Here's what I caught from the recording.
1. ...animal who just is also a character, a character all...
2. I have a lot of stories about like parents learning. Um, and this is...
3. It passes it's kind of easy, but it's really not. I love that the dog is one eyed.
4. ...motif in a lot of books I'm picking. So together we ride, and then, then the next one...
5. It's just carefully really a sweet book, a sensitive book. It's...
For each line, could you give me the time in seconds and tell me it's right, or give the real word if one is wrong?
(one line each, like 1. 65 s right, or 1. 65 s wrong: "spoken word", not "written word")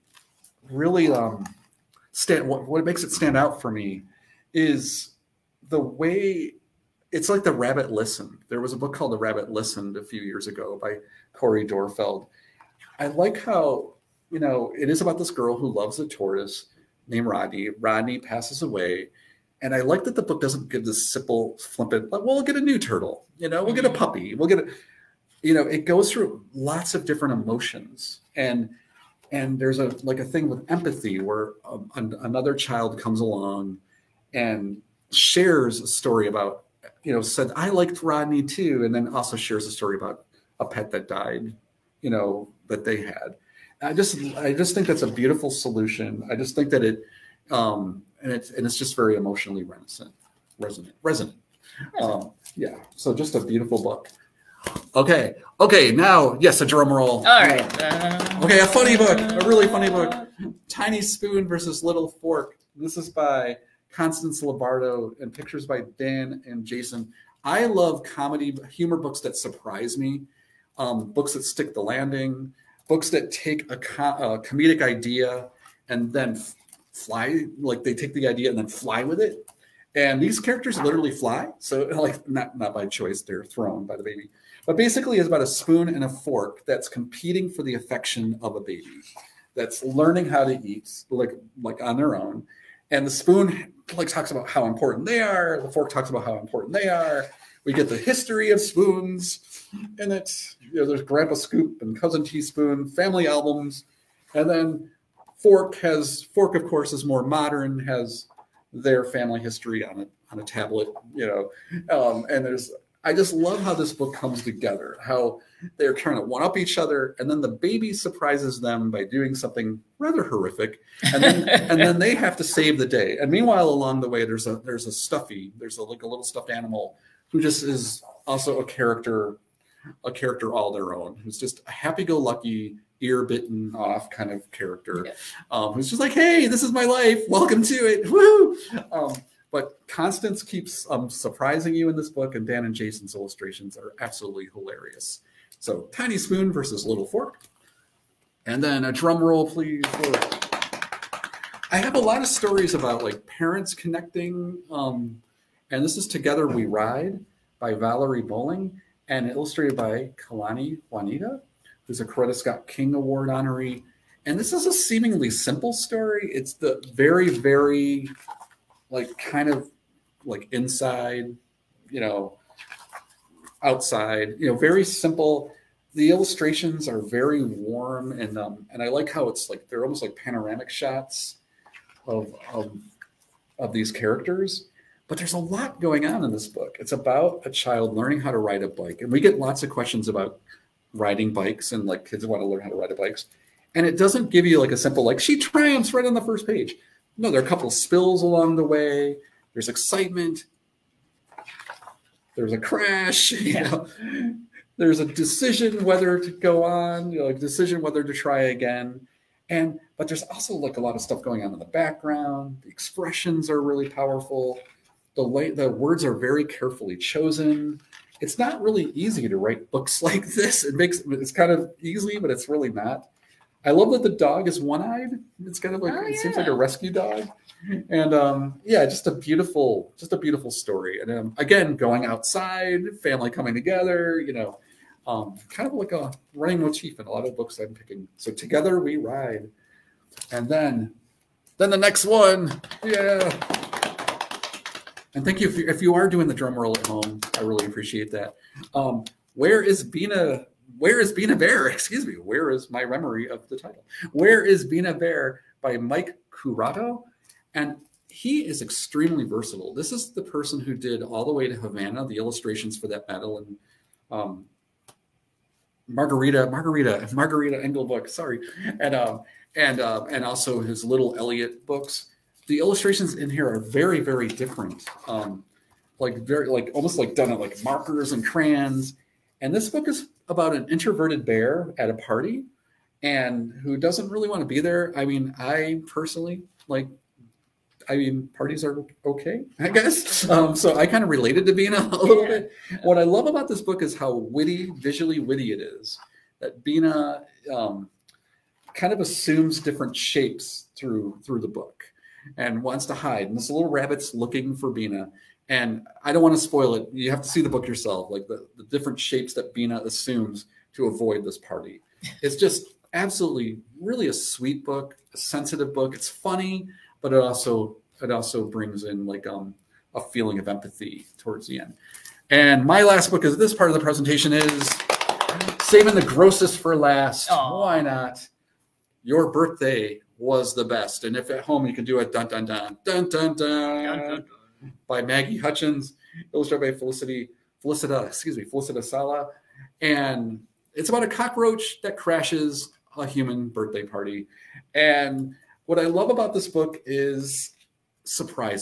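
1. 126 s right
2. 151 s wrong: "connecting", not "learning"
3. 220 s wrong: "makes", not "passes"
4. 236 s right
5. 312 s wrong: "absolutely", not "carefully".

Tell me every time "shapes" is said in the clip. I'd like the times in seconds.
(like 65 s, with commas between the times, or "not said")
299 s, 308 s.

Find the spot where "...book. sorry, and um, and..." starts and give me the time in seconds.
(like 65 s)
267 s.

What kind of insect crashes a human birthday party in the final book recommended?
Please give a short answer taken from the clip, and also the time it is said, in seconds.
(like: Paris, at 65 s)
cockroach, at 341 s.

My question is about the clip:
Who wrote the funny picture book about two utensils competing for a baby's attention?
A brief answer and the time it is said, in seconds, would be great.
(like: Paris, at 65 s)
Constance Lombardo, at 63 s.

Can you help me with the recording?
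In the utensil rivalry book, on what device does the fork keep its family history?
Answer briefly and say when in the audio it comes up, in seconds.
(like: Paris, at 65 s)
a tablet, at 110 s.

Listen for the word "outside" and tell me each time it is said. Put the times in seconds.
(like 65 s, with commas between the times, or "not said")
173 s, 232 s.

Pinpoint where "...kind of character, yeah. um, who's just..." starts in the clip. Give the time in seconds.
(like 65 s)
134 s.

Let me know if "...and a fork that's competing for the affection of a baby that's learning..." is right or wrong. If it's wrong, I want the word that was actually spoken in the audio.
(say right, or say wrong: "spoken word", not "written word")
right.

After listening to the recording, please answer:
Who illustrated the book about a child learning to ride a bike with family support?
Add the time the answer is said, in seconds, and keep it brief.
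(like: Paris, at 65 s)
Kaylani Juanita, at 160 s.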